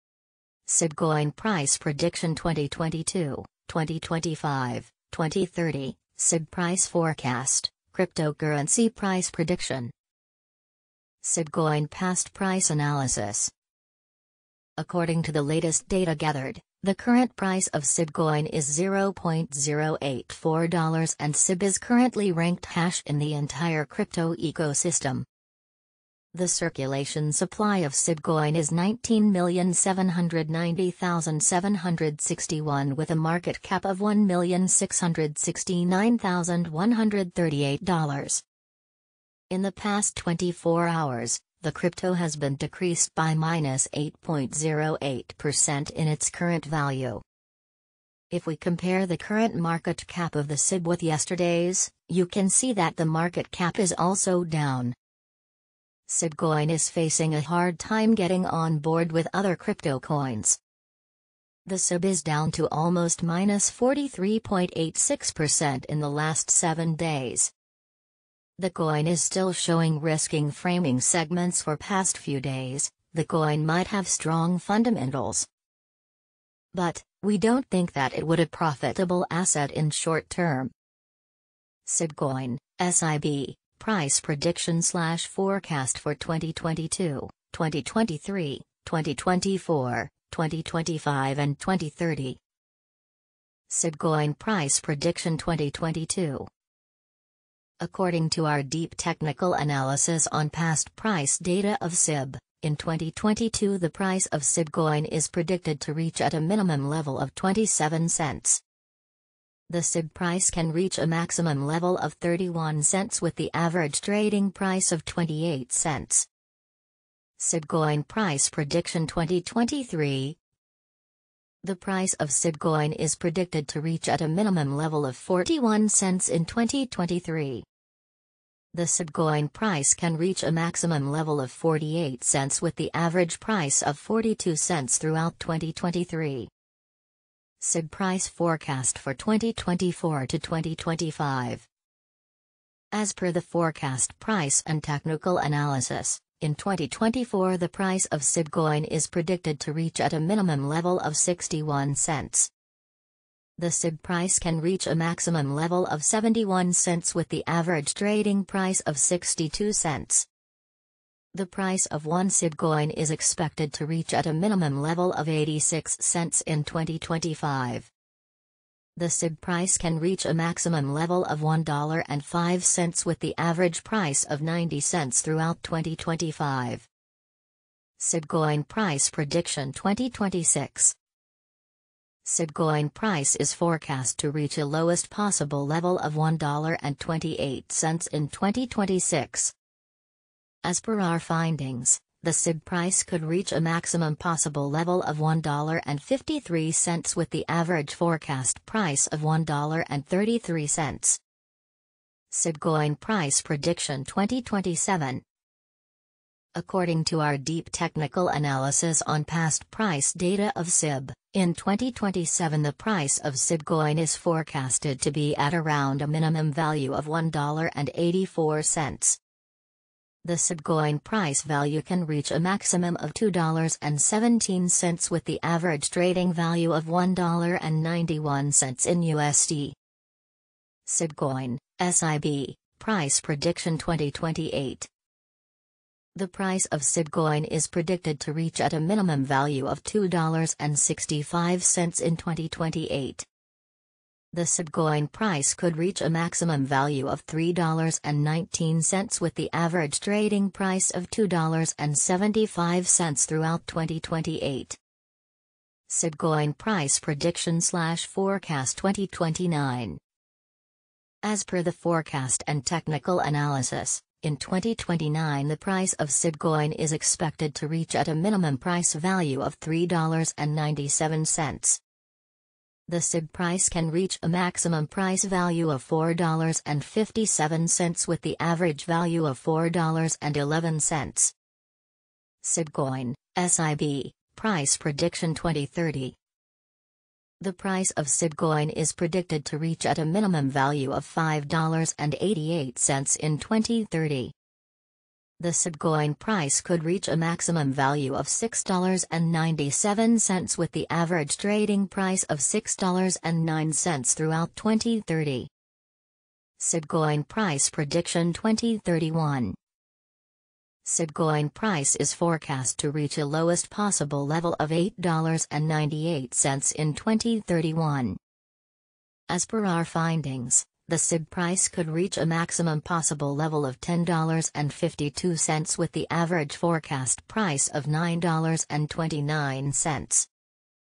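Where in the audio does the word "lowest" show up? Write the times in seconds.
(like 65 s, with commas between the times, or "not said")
184 s, 313 s.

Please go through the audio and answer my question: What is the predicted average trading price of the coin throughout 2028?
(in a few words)
$2.75.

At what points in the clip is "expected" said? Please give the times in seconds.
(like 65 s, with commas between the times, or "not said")
163 s, 266 s.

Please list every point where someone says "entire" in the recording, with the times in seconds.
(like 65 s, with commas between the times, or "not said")
23 s.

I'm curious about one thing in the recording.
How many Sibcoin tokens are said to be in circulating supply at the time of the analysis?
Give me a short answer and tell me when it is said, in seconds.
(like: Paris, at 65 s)
19,790,761, at 28 s.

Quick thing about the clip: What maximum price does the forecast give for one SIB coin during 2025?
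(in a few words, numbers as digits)
$1.05.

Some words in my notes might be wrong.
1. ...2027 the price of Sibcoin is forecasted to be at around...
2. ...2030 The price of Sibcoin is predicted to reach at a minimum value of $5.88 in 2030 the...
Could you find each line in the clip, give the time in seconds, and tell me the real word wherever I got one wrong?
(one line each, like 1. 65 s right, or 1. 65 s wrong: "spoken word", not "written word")
1. 211 s right
2. 285 s right.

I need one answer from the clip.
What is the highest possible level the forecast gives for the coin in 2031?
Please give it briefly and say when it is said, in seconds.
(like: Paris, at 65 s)
$10.52, at 323 s.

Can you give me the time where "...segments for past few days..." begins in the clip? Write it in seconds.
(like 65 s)
70 s.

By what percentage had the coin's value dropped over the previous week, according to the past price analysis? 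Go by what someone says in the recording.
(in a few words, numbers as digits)
-43.86%.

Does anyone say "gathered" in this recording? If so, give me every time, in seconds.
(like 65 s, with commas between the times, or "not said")
16 s.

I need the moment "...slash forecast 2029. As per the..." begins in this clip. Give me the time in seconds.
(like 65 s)
257 s.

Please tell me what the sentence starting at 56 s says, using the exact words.
Sibcoin is facing a hard time getting on board with other crypto coins.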